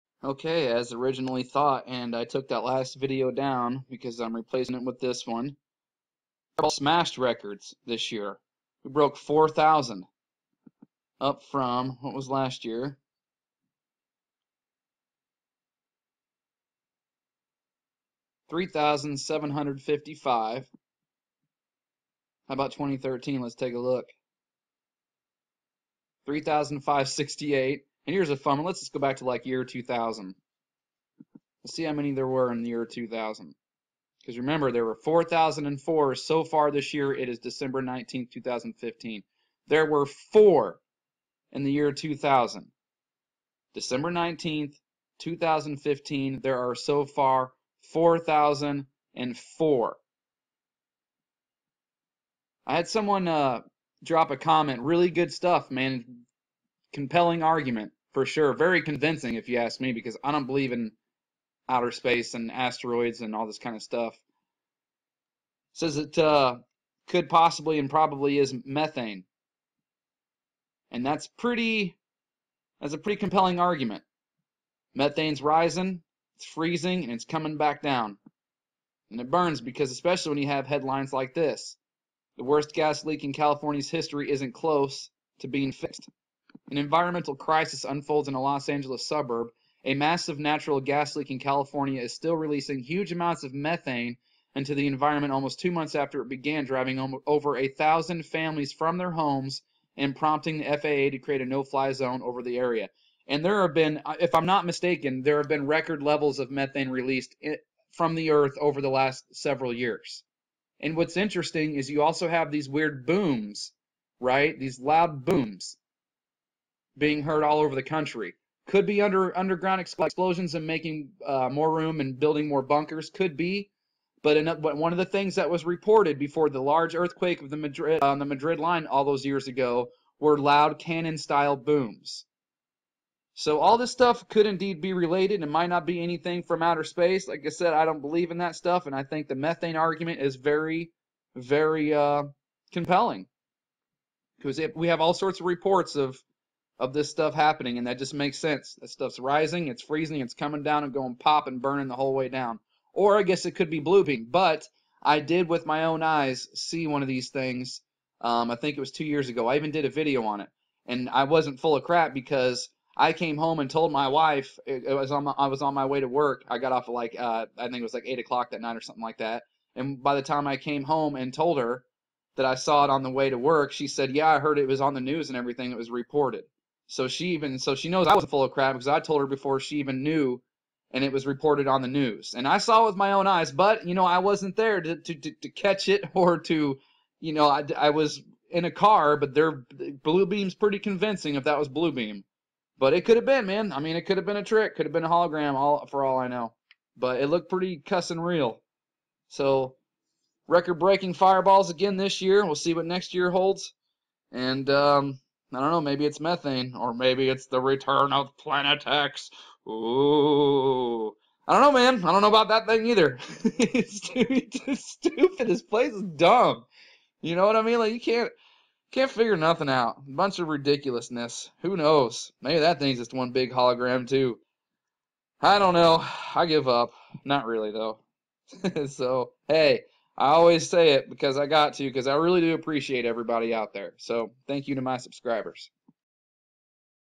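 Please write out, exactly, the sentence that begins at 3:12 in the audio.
But it could have been, man.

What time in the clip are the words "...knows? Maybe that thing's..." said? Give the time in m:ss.
3:41.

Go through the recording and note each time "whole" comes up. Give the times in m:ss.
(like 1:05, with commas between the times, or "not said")
2:31.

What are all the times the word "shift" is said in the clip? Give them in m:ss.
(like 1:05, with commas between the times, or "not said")
not said.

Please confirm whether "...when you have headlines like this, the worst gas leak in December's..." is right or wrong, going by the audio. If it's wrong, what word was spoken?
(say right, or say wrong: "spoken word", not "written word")
wrong: "California", not "December".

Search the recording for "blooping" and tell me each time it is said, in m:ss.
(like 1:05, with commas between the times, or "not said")
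2:33.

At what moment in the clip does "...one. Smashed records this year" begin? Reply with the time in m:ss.
0:05.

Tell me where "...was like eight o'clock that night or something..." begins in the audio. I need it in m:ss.
2:47.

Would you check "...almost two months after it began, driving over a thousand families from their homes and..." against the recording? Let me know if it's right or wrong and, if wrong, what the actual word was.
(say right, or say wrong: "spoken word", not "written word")
right.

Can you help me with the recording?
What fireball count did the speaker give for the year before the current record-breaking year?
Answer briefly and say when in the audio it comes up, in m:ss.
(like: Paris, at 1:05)
3,755, at 0:18.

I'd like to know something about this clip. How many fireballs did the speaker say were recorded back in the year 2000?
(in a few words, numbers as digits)
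4.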